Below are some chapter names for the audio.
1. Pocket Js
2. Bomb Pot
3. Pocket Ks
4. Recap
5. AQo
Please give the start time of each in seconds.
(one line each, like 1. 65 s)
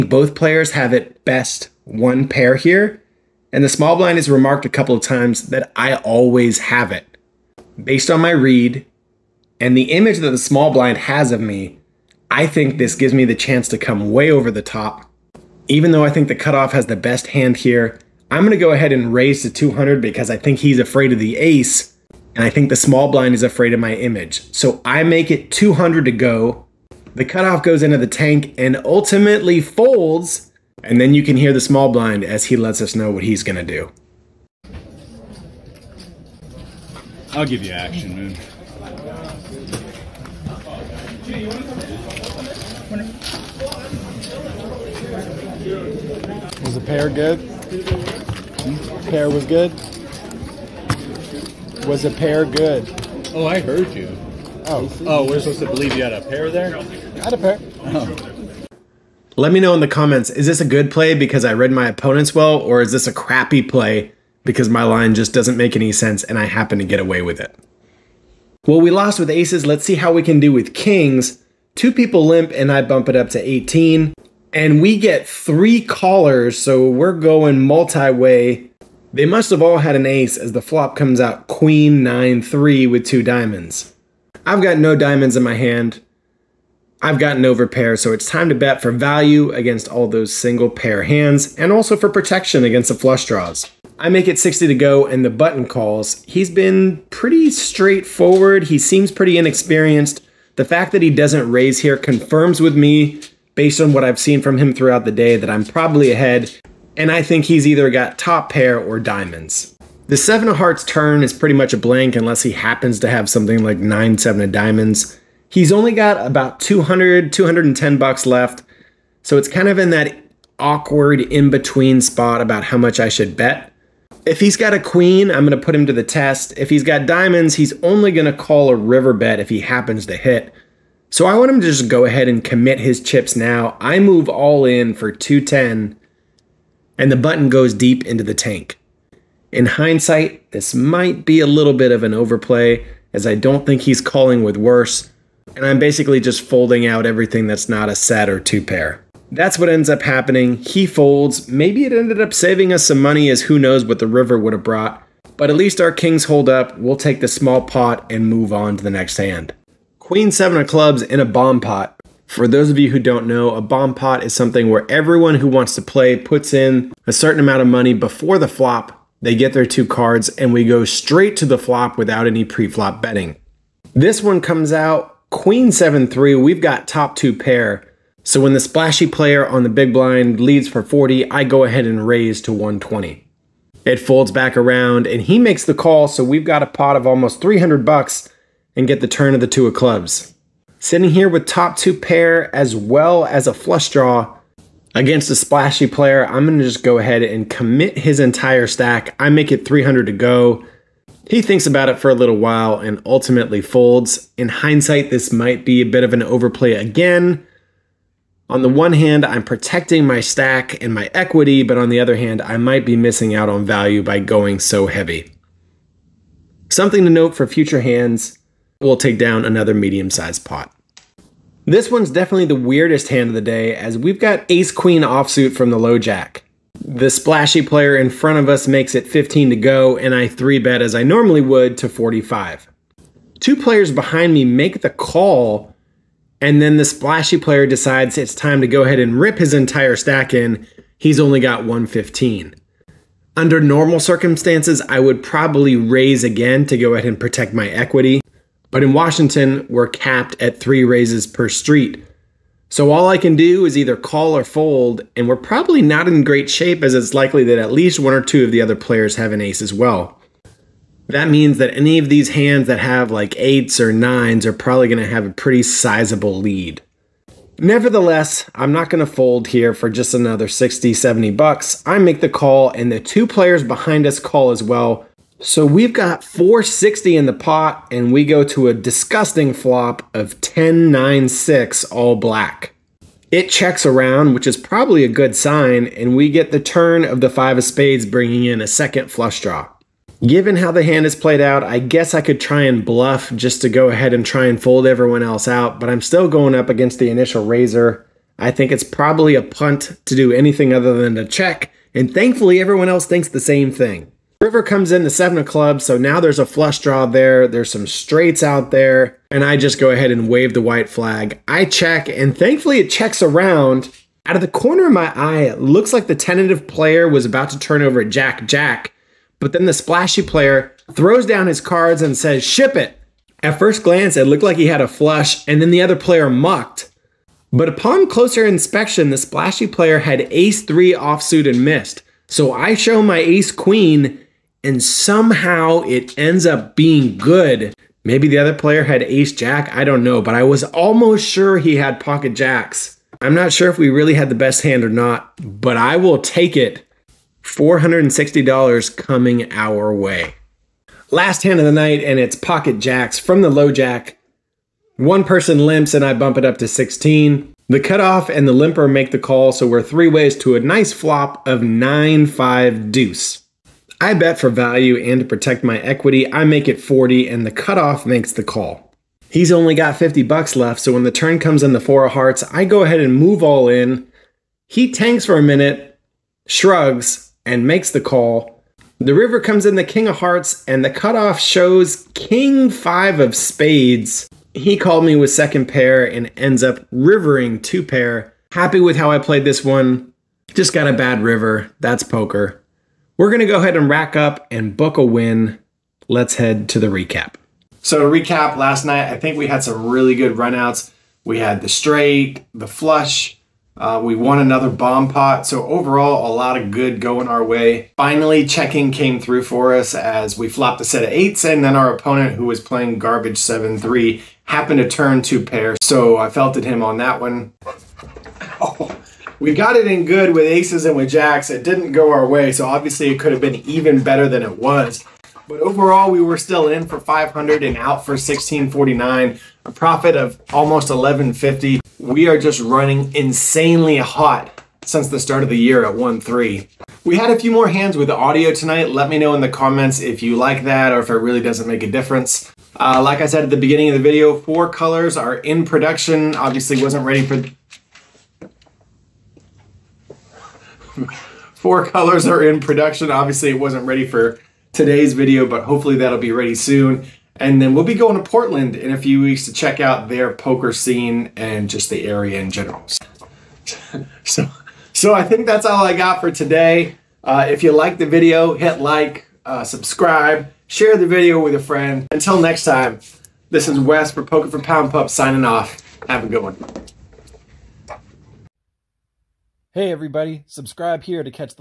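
1. 352 s
2. 161 s
3. 69 s
4. 392 s
5. 223 s.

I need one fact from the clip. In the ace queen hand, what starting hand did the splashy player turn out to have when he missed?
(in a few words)
ace three offsuit.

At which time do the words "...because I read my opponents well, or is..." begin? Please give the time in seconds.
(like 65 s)
61 s.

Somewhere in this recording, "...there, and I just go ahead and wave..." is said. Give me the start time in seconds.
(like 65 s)
308 s.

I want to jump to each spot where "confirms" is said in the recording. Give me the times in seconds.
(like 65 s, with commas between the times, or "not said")
101 s.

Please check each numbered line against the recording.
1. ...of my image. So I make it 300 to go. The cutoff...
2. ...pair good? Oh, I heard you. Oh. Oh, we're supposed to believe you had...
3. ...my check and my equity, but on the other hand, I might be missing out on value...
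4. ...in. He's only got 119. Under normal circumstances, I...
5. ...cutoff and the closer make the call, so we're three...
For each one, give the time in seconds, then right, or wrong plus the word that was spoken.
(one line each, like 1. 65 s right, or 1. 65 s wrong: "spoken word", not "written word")
1. 23 s wrong: "200", not "300"
2. 52 s right
3. 210 s wrong: "stack", not "check"
4. 240 s wrong: "115", not "119"
5. 357 s wrong: "limper", not "closer".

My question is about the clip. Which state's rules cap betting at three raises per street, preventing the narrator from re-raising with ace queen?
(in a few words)
Washington.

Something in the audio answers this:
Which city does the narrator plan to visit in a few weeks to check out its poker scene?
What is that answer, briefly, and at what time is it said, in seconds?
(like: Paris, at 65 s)
Portland, at 458 s.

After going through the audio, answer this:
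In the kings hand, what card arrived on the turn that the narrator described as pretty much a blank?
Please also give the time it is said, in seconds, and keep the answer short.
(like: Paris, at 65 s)
seven of hearts, at 110 s.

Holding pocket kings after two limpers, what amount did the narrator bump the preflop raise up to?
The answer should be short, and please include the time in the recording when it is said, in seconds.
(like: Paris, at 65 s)
18, at 73 s.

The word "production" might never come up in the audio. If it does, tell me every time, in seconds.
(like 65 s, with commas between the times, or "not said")
445 s, 452 s.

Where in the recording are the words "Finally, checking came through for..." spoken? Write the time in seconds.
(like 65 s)
407 s.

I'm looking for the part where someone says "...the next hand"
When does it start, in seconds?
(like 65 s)
158 s.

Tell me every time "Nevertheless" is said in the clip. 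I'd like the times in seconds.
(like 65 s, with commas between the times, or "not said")
267 s.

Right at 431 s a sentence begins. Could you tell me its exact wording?
We are just running insanely hot since the start of the year at 1-3.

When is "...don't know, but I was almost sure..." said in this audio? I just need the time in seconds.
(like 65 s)
339 s.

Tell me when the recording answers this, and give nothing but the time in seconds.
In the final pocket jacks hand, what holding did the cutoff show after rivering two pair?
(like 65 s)
382 s.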